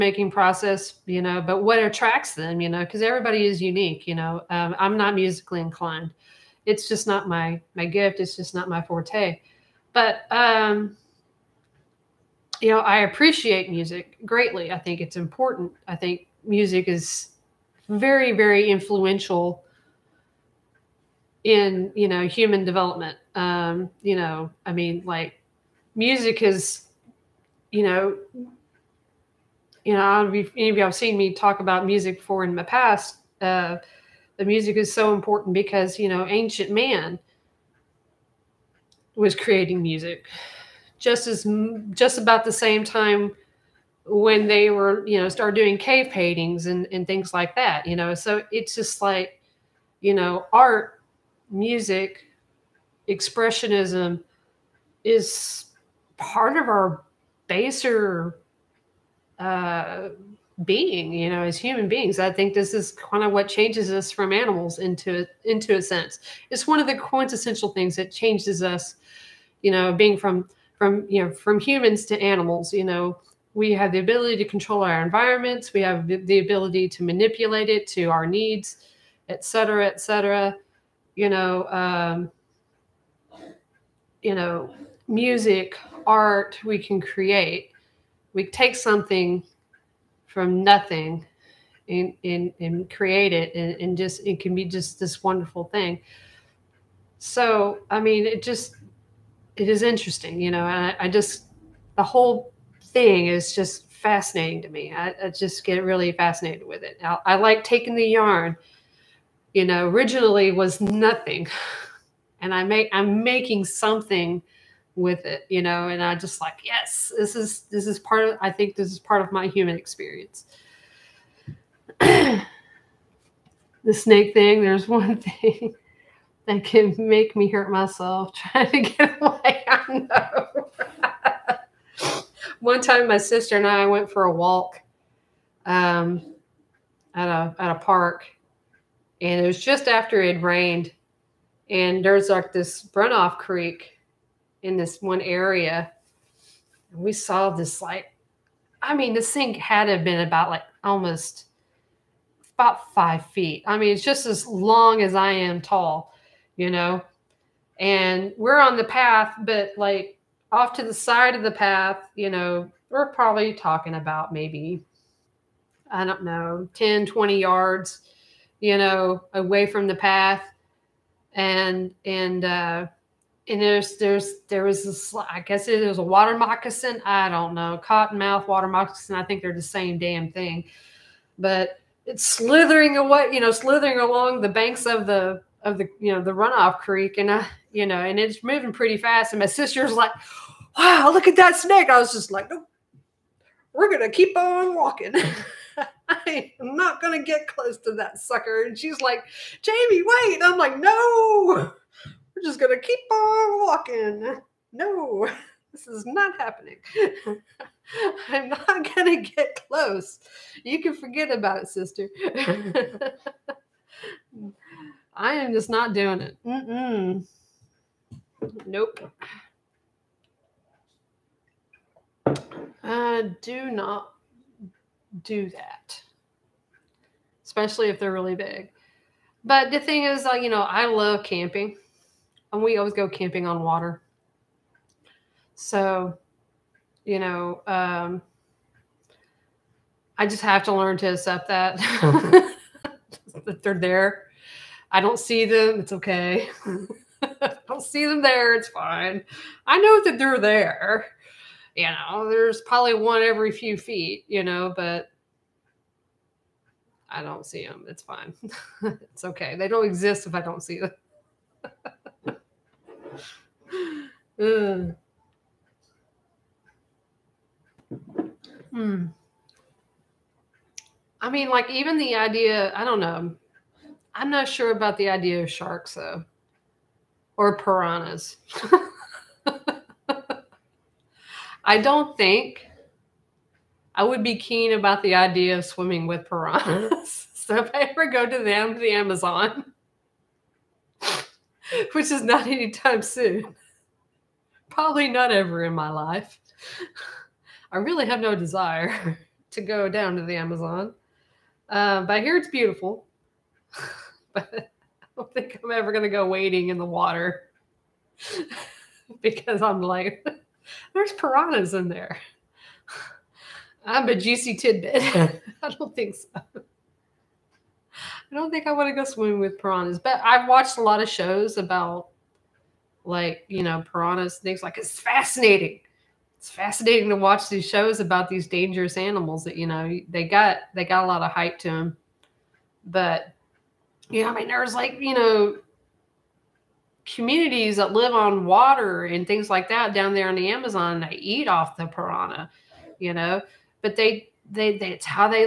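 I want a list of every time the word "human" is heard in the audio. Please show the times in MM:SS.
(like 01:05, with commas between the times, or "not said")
00:22, 01:01, 01:11, 01:59.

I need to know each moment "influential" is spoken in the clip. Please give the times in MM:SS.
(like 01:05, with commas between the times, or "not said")
00:18.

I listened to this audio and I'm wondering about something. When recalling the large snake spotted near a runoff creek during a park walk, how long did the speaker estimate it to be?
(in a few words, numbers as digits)
5 feet.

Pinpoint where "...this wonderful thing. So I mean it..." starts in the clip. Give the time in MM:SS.
01:34.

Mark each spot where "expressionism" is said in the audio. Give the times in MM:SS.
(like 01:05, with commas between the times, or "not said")
00:53.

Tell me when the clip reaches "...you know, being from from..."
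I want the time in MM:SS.
01:09.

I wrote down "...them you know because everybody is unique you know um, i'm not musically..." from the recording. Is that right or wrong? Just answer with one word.
right.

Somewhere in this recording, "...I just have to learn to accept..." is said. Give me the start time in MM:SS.
04:00.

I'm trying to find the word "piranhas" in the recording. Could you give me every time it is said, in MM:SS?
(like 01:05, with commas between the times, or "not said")
04:37, 04:46, 05:11, 05:19, 05:23, 05:41.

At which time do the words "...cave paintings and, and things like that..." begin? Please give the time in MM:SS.
00:45.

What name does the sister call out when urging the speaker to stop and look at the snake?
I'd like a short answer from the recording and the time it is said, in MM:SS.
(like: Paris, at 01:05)
Jaime, at 03:19.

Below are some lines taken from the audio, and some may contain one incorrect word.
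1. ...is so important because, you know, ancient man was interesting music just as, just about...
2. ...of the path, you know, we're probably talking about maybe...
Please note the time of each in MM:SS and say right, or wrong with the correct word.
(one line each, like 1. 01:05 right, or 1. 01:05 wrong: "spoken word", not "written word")
1. 00:34 wrong: "creating", not "interesting"
2. 02:41 right.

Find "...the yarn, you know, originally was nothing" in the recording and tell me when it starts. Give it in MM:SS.
01:47.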